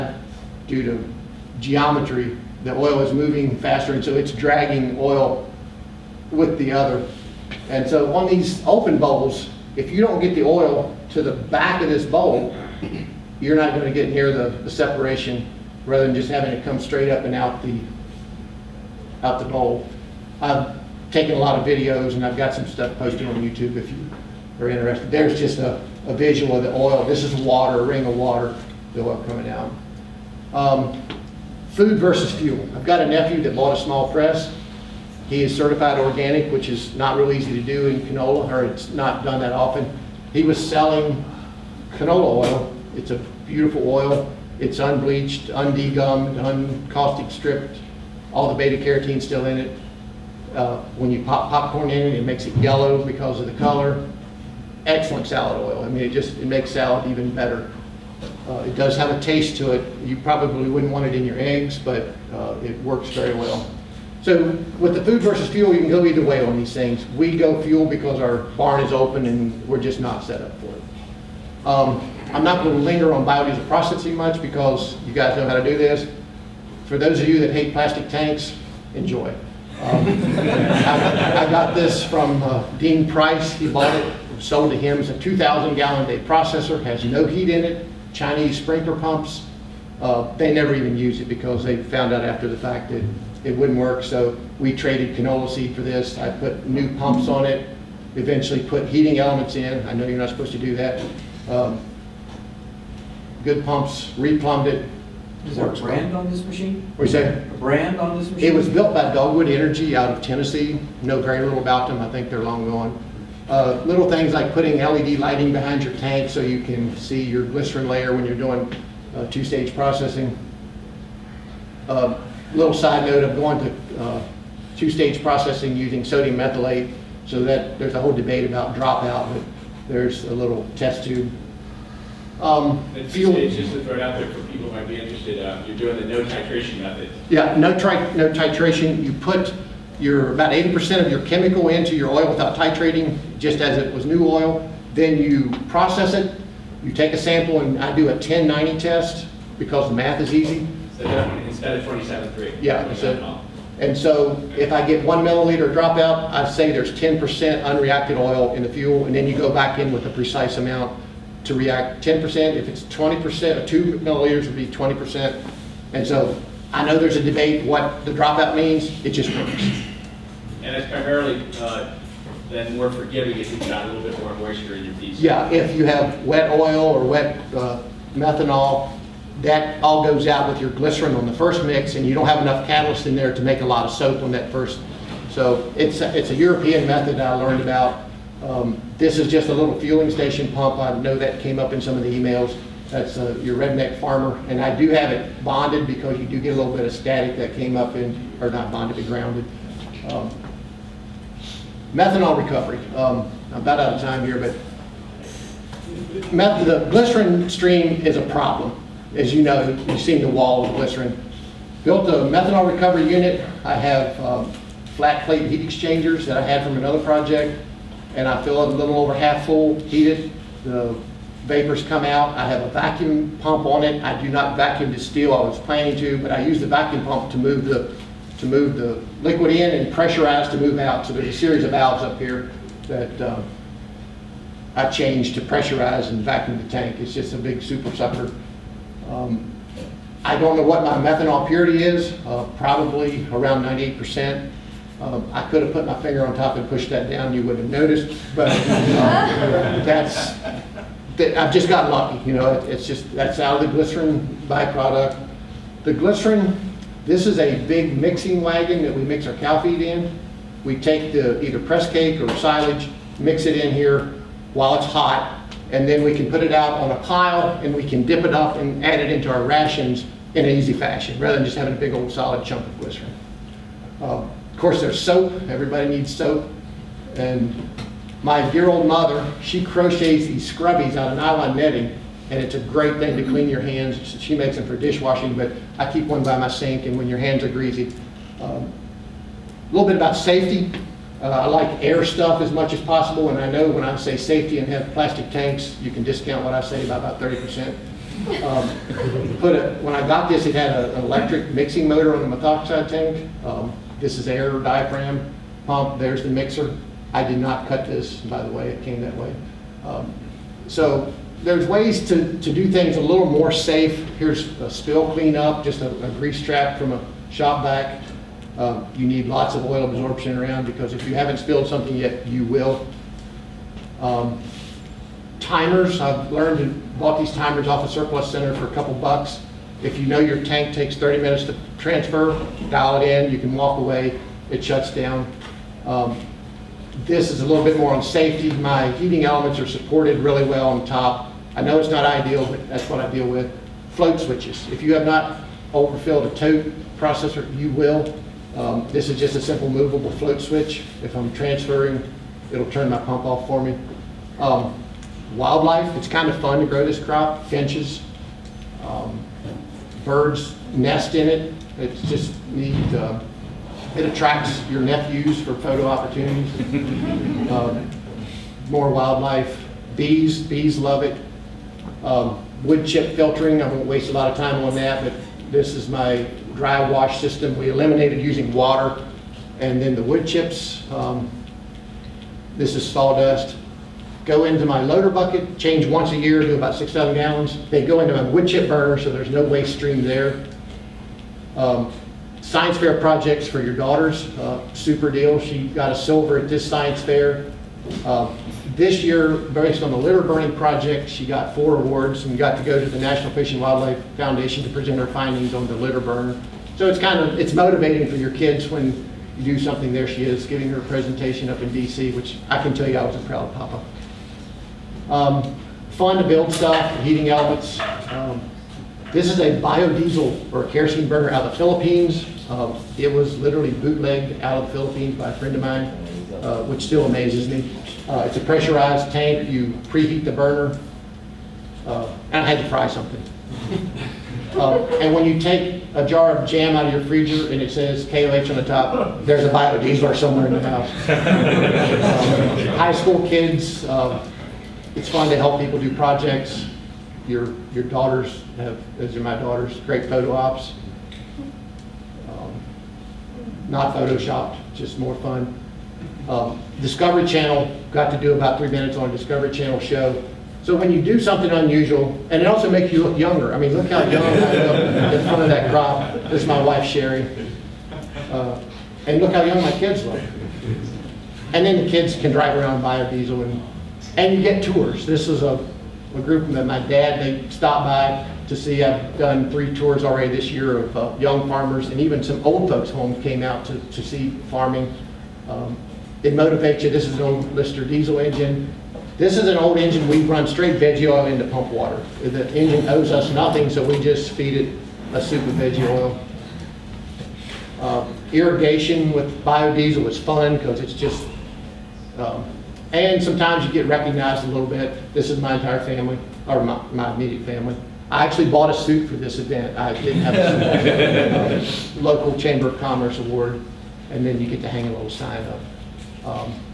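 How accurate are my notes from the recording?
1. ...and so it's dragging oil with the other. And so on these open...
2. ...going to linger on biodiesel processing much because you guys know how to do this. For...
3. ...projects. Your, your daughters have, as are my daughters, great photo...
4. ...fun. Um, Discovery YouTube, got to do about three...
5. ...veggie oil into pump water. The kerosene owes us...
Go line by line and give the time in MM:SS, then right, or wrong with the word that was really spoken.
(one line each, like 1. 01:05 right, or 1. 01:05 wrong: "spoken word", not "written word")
1. 00:03 right
2. 01:12 right
3. 07:25 right
4. 07:35 wrong: "Channel", not "YouTube"
5. 08:10 wrong: "engine", not "kerosene".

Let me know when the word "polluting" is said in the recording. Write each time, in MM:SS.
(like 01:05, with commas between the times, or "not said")
not said.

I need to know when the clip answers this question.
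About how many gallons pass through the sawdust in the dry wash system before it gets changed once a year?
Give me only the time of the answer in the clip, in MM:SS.
06:26.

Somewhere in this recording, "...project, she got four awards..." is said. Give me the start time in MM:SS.
06:40.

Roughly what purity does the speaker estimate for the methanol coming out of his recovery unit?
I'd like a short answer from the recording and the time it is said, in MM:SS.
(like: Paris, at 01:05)
98%, at 04:03.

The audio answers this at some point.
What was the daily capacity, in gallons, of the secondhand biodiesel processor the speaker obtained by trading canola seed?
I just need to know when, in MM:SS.
01:25.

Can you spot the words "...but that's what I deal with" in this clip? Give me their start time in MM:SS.
05:42.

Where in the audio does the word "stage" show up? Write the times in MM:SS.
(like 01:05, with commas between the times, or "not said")
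01:59, 02:04, 02:13.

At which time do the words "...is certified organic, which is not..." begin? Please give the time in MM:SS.
00:35.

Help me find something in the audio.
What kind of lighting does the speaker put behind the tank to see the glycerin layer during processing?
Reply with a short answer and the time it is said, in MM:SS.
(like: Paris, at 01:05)
LED lighting, at 01:54.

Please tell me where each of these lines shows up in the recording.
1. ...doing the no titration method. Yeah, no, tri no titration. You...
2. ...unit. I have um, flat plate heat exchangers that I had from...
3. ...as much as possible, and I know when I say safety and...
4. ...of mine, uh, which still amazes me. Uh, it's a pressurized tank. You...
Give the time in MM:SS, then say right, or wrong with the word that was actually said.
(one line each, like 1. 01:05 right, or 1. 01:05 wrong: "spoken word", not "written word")
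1. 02:15 right
2. 03:33 right
3. 04:52 right
4. 07:05 right.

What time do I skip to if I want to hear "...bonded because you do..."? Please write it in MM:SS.
03:15.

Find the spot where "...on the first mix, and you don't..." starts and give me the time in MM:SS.
03:01.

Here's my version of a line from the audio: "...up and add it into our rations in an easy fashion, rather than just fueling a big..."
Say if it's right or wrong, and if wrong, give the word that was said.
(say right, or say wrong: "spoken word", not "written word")
wrong: "having", not "fueling".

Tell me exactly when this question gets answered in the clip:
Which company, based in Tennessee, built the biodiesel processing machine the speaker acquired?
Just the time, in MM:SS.
01:49.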